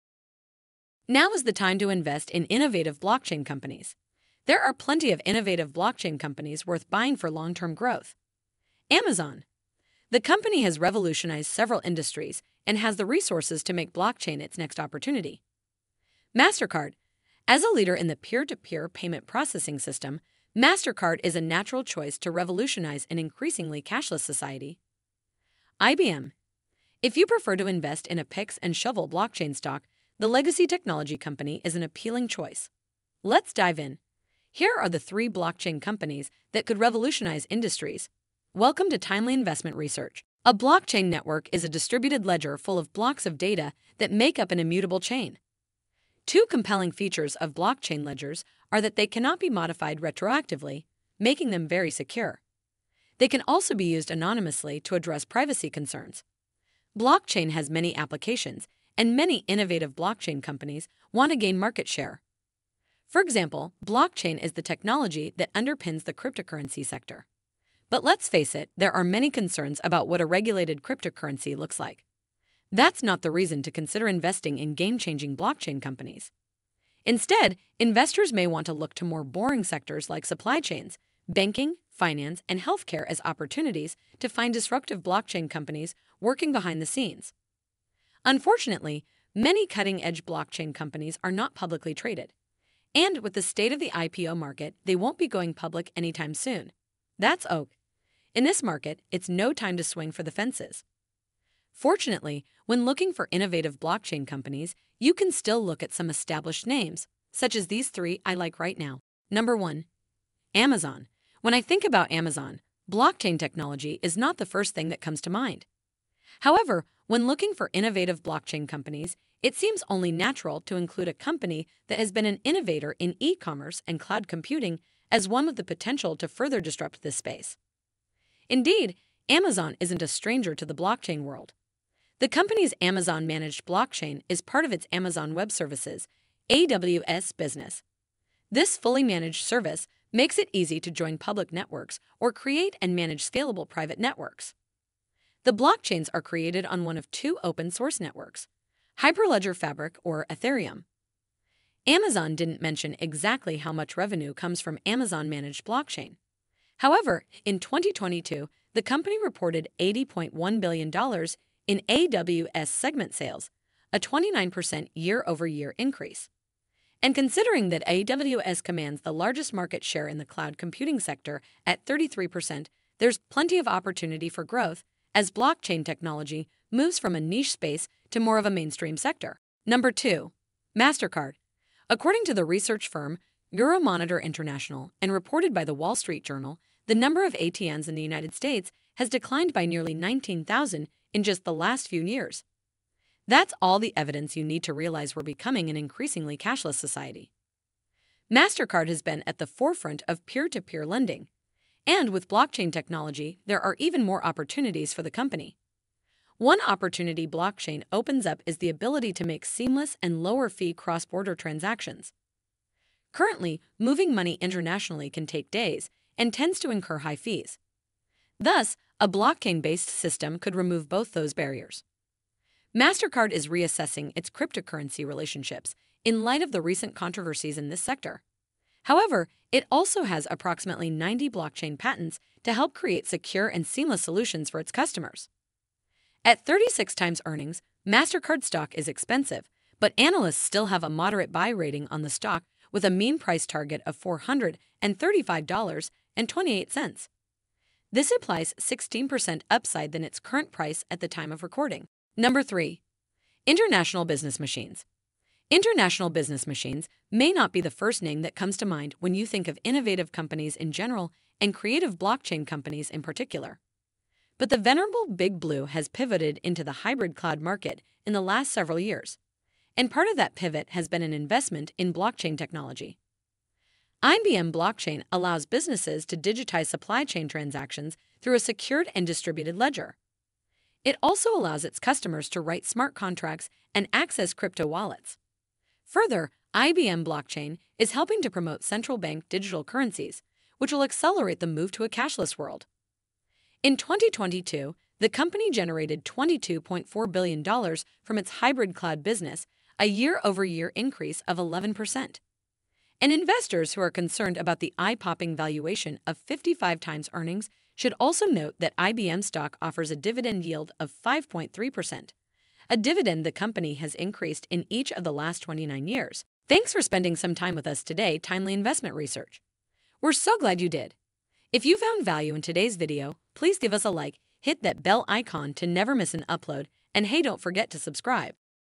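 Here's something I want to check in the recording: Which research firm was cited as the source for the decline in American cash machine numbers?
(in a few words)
Euromonitor International.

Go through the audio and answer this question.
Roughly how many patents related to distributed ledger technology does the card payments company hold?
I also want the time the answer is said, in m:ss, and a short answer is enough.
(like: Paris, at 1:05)
90, at 3:50.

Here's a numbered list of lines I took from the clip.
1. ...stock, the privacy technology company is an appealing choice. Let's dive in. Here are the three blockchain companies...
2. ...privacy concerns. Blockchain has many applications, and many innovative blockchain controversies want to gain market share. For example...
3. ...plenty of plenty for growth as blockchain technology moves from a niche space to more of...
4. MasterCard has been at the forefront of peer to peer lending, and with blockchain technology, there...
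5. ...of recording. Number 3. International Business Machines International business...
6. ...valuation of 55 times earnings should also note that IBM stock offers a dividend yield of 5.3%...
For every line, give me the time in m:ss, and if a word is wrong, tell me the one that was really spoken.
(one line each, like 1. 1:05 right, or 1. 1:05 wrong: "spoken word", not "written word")
1. 0:29 wrong: "legacy", not "privacy"
2. 0:55 wrong: "companies", not "controversies"
3. 2:53 wrong: "opportunity", not "plenty"
4. 3:18 right
5. 4:11 right
6. 5:05 right.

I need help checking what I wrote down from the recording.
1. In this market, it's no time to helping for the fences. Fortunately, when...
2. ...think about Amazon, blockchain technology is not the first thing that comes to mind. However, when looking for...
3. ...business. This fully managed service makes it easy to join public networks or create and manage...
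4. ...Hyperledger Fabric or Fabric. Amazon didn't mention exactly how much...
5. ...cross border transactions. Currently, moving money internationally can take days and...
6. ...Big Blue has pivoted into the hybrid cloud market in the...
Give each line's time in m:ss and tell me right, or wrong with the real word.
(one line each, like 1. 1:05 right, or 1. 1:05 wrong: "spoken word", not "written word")
1. 1:38 wrong: "swing", not "helping"
2. 1:51 right
3. 2:17 right
4. 2:28 wrong: "Ethereum", not "Fabric"
5. 3:30 right
6. 4:25 right.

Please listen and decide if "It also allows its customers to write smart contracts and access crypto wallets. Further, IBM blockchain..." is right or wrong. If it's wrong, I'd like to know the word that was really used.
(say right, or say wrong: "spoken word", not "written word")
right.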